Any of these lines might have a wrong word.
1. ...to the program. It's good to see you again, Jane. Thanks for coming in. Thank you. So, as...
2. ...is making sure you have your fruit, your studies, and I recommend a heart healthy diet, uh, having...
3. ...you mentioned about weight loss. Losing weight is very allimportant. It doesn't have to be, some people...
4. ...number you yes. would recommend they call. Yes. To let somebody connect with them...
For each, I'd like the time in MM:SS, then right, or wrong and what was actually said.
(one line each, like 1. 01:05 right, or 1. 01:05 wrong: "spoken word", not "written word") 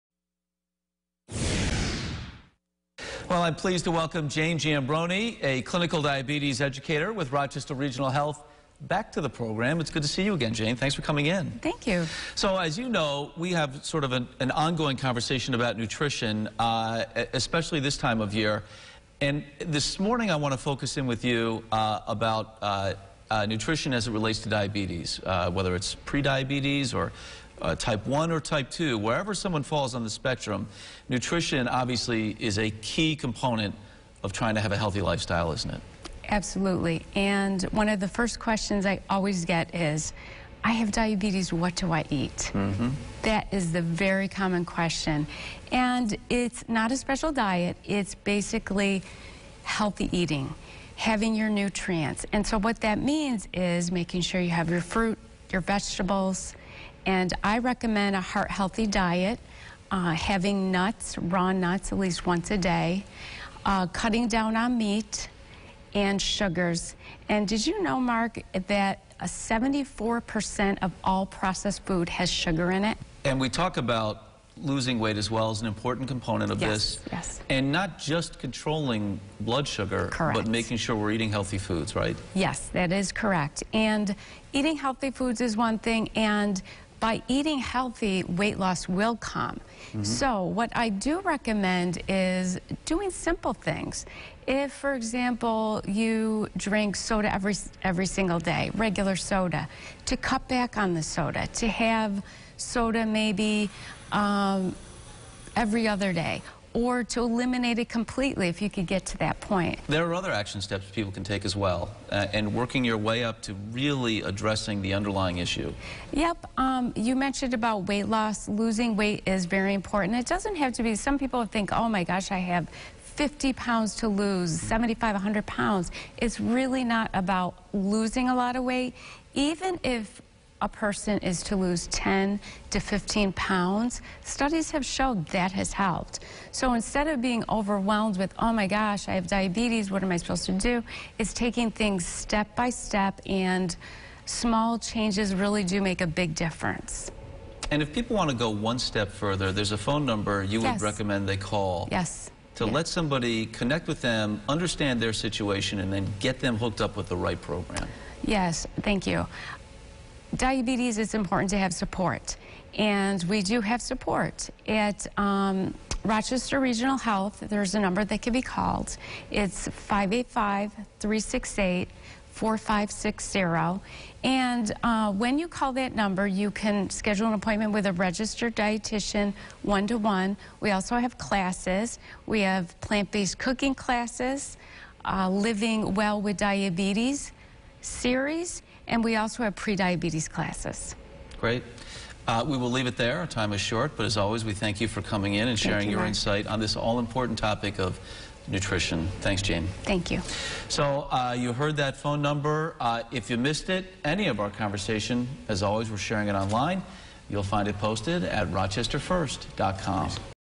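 1. 00:09 right
2. 00:53 wrong: "vegetables", not "studies"
3. 01:56 wrong: "important", not "allimportant"
4. 02:30 right.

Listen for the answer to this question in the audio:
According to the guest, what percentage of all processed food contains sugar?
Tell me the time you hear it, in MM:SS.
01:09.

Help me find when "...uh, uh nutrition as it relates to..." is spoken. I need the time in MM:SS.
00:22.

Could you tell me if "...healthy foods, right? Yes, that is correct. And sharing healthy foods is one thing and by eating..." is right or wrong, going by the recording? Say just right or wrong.
wrong.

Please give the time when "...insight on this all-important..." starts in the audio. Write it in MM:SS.
03:16.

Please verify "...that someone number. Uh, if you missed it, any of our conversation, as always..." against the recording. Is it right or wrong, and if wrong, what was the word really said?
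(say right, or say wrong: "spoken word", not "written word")
wrong: "phone", not "someone".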